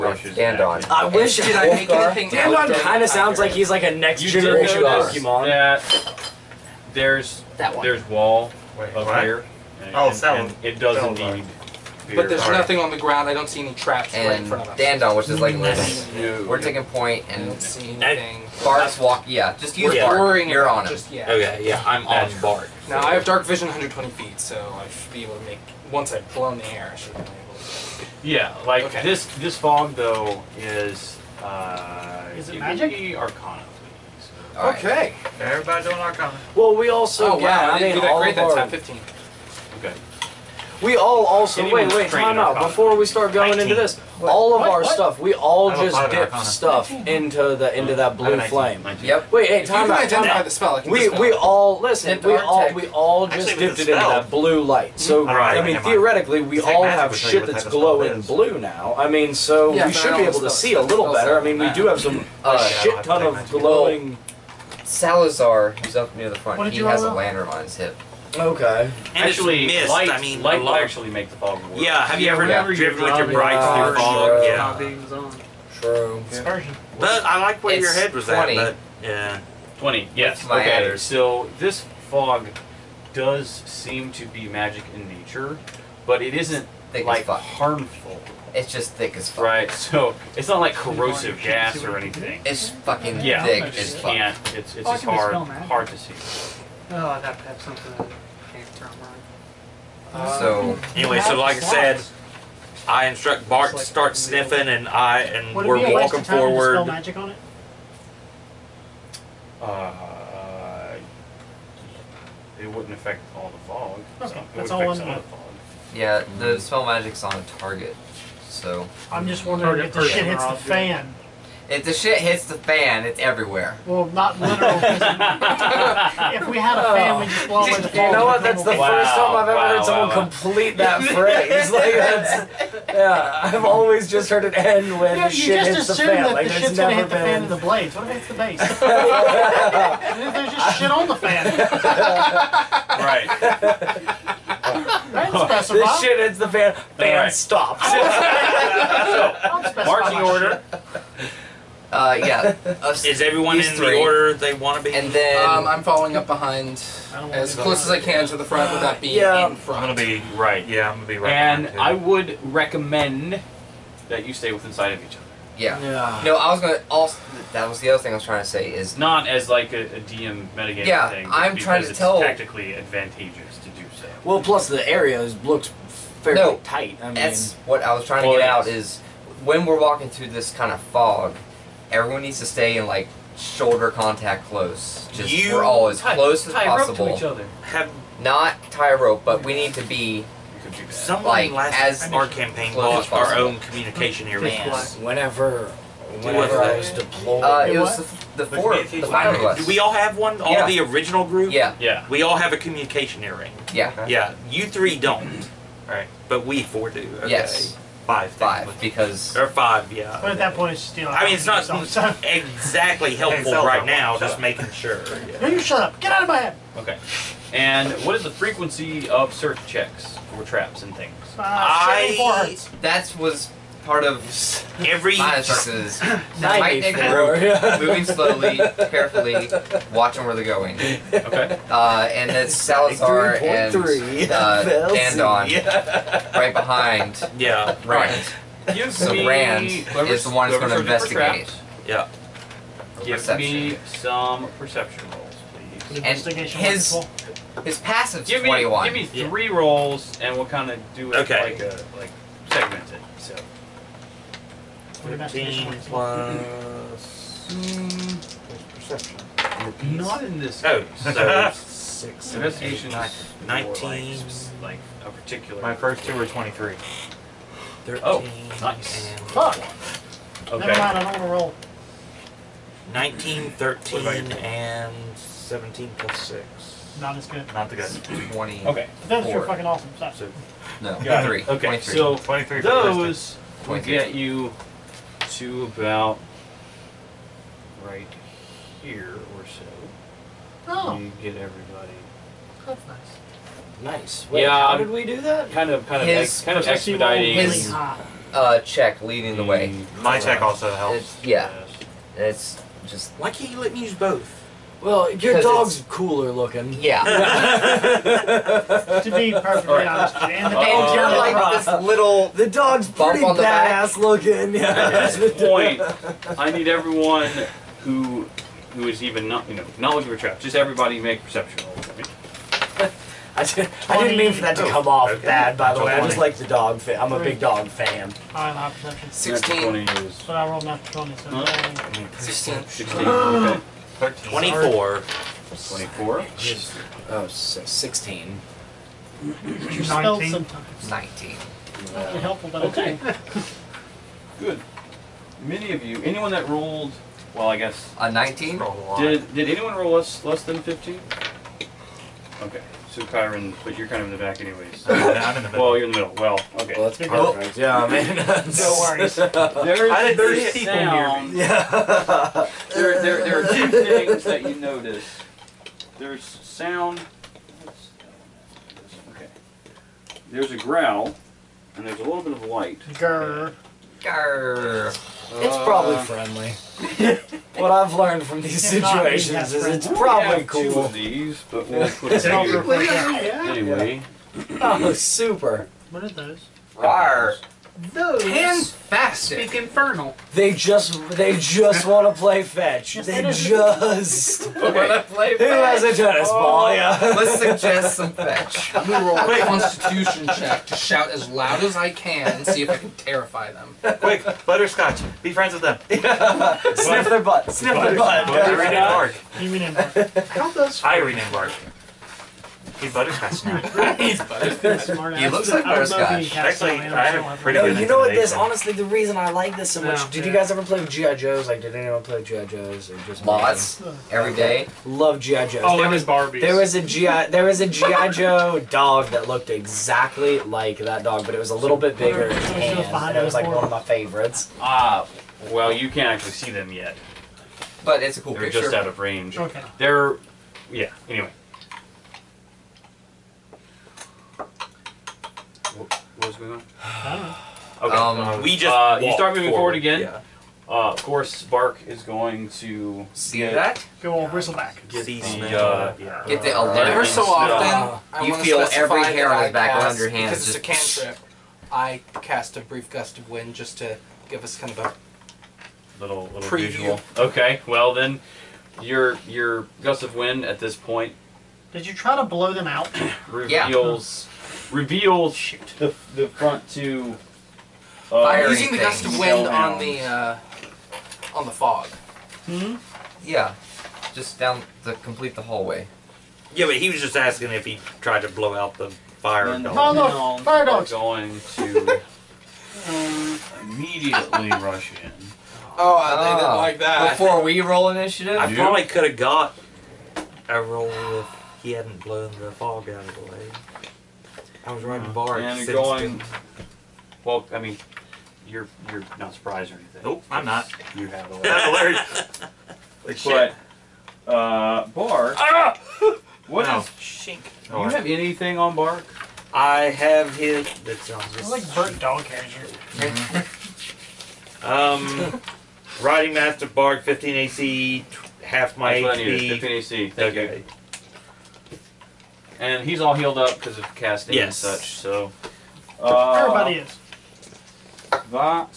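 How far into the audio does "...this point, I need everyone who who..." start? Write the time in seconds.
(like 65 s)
315 s.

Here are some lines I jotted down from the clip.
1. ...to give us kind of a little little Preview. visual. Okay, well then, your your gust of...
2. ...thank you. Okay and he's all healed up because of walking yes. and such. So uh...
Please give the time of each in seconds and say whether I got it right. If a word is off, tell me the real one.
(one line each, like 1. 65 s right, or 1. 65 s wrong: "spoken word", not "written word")
1. 463 s right
2. 530 s wrong: "casting", not "walking".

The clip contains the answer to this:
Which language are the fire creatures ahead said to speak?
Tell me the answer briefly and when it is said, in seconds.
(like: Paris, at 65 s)
Infernal, at 389 s.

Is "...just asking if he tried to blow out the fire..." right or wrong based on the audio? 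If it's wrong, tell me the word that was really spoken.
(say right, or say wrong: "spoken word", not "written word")
right.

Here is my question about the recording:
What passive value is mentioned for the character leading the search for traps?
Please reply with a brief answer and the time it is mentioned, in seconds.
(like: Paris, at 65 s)
21, at 248 s.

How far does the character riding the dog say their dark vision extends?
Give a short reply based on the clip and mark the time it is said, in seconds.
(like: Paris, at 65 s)
120 feet, at 23 s.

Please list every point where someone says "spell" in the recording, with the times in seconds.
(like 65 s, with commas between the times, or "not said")
50 s, 95 s, 106 s, 116 s.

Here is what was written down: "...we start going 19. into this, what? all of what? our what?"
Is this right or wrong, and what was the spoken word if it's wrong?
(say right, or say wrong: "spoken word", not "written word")
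right.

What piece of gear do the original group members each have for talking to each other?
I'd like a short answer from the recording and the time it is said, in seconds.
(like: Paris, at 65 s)
communication earring, at 202 s.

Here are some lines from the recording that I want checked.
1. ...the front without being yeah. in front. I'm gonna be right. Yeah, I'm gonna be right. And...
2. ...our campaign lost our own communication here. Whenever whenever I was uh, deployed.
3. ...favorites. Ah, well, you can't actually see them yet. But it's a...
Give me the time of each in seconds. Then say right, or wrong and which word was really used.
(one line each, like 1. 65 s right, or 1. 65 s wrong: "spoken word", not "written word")
1. 158 s right
2. 192 s right
3. 433 s right.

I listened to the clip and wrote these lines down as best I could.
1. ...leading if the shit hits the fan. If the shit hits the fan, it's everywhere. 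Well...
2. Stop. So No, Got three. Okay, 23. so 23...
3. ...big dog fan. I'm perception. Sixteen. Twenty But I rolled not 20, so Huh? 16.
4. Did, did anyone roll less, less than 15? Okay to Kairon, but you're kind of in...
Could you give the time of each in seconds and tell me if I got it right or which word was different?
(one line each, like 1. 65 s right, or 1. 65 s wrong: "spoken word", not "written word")
1. 119 s wrong: "wondering", not "leading"
2. 279 s right
3. 327 s right
4. 348 s right.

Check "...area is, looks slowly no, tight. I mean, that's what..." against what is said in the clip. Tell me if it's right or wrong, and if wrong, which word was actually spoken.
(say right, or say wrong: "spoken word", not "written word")
wrong: "fairly", not "slowly".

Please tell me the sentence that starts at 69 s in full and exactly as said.
light, I mean, light will actually make the fog work.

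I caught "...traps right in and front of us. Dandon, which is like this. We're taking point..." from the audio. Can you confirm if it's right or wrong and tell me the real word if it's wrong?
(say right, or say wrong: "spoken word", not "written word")
right.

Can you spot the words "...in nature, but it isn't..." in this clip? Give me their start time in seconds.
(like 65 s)
84 s.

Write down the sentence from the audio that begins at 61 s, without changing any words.
I mean, we do have some oh, uh, shit ton of glowing.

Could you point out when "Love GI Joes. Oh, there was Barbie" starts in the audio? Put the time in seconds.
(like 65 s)
424 s.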